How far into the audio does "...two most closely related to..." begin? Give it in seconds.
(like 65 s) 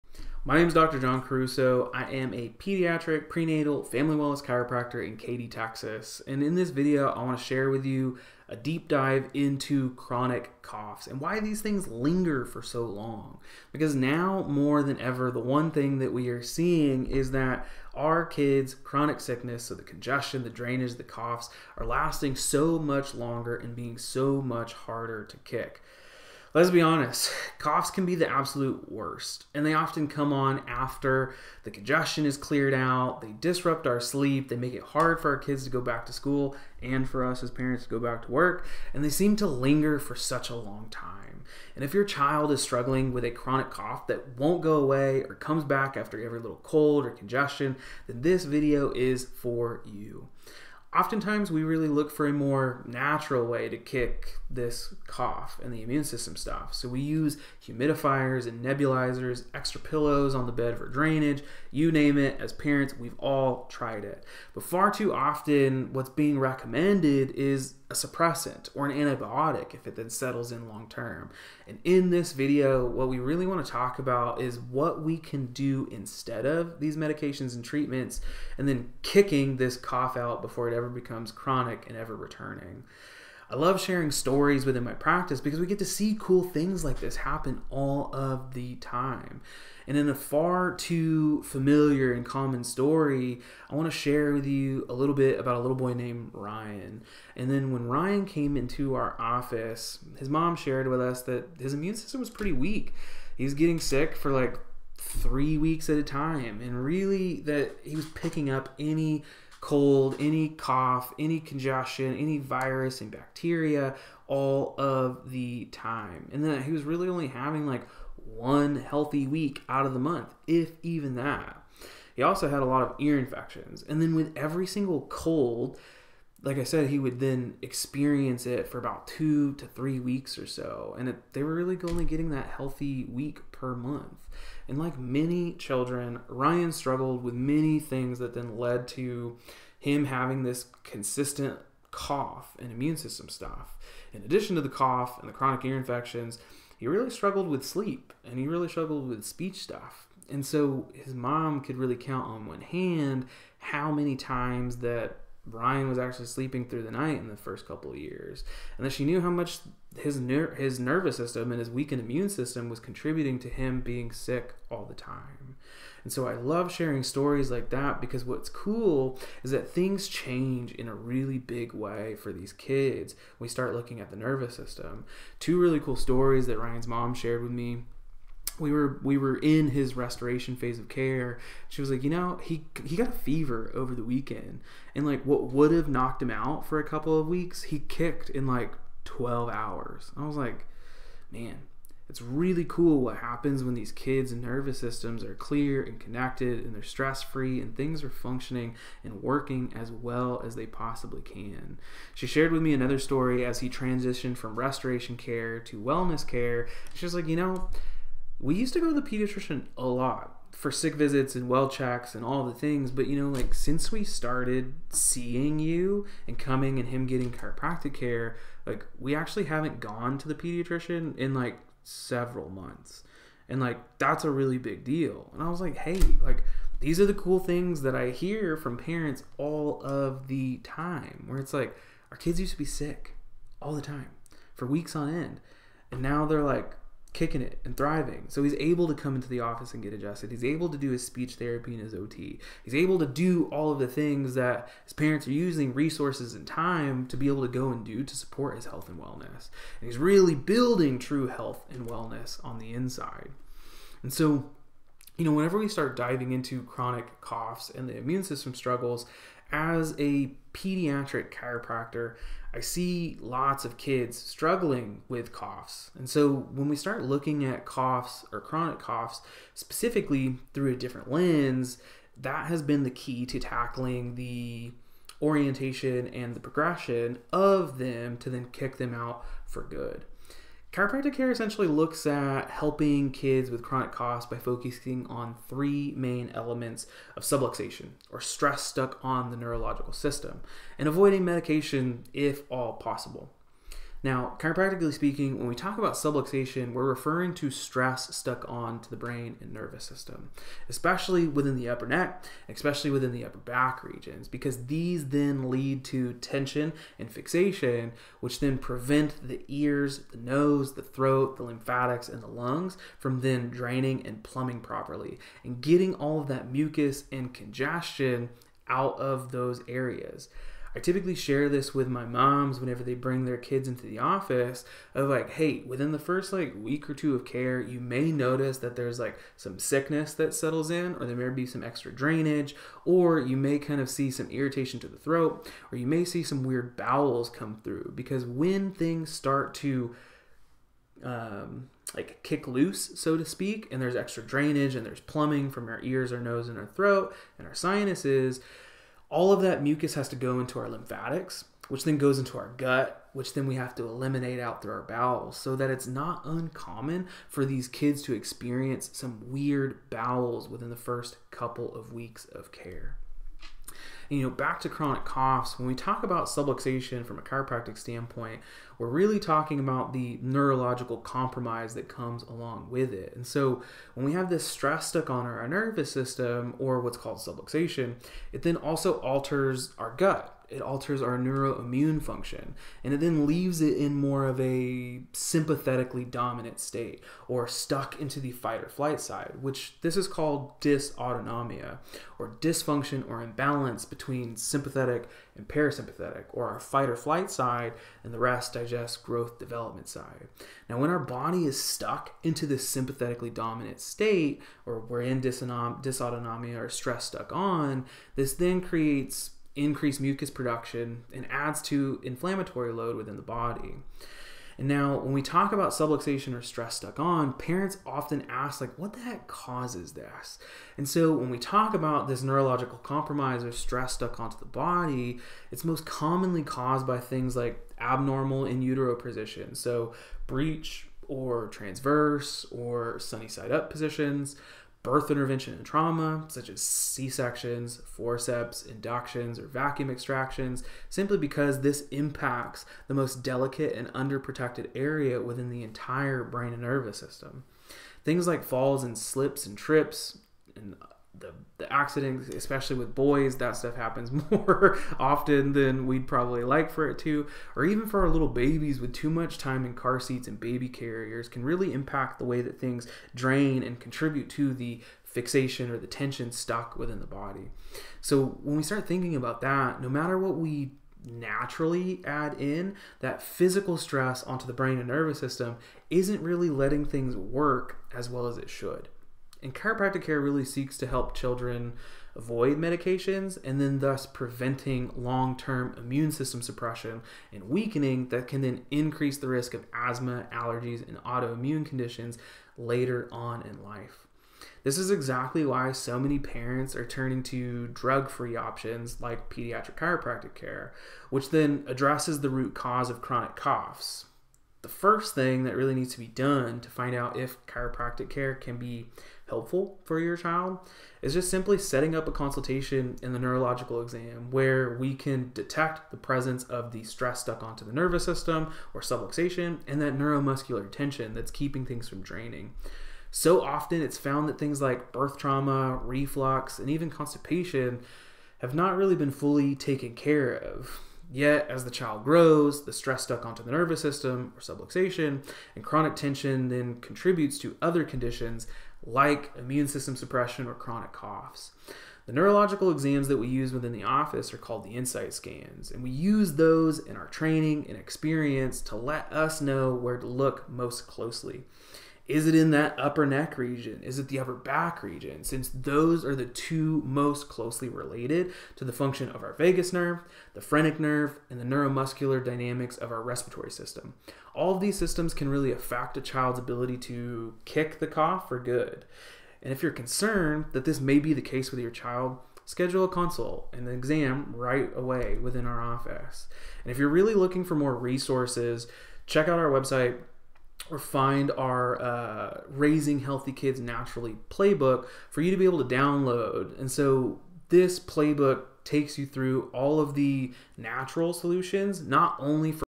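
556 s.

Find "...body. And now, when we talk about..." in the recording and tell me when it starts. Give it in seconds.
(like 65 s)
413 s.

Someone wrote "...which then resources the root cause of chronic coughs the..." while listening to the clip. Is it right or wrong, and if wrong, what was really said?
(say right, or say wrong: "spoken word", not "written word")
wrong: "addresses", not "resources".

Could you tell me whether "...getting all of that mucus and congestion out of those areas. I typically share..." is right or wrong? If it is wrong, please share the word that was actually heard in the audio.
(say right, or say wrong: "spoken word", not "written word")
right.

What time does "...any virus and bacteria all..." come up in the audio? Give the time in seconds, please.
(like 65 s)
112 s.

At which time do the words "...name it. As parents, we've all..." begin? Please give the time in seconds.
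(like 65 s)
61 s.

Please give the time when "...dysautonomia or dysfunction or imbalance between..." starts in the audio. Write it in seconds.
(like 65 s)
390 s.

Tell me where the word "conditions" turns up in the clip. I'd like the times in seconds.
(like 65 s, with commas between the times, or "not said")
491 s, 537 s.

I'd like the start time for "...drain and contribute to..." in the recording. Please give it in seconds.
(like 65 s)
463 s.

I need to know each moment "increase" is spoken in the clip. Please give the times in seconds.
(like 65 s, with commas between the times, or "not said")
409 s, 488 s.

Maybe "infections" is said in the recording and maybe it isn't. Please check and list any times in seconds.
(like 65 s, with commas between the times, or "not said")
123 s, 145 s.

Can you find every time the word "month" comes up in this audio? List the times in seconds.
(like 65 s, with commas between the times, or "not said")
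119 s, 133 s, 222 s.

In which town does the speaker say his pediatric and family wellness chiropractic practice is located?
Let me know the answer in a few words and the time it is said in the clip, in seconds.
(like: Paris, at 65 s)
Katy, Texas, at 5 s.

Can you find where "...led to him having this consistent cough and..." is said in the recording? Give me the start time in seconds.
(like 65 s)
138 s.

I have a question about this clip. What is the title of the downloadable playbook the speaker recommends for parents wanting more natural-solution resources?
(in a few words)
Raising Healthy Kids Naturally.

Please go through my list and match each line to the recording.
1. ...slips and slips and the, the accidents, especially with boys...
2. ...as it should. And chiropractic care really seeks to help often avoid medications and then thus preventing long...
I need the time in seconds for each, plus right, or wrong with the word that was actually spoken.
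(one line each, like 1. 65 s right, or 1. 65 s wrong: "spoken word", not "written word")
1. 448 s wrong: "trips", not "slips"
2. 478 s wrong: "children", not "often".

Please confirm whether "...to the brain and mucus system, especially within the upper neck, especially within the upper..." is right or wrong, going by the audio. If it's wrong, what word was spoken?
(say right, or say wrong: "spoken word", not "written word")
wrong: "nervous", not "mucus".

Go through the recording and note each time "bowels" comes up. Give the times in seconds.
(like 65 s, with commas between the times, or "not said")
336 s, 354 s, 359 s.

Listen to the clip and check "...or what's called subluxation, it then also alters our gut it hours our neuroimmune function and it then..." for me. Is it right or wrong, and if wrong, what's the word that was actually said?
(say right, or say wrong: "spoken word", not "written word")
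wrong: "alters", not "hours".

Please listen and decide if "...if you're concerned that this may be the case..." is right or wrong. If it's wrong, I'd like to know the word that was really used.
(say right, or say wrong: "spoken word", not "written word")
right.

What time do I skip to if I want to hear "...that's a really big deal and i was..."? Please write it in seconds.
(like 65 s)
223 s.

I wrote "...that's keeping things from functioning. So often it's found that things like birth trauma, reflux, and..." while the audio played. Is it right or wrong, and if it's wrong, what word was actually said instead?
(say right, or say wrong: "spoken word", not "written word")
wrong: "draining", not "functioning".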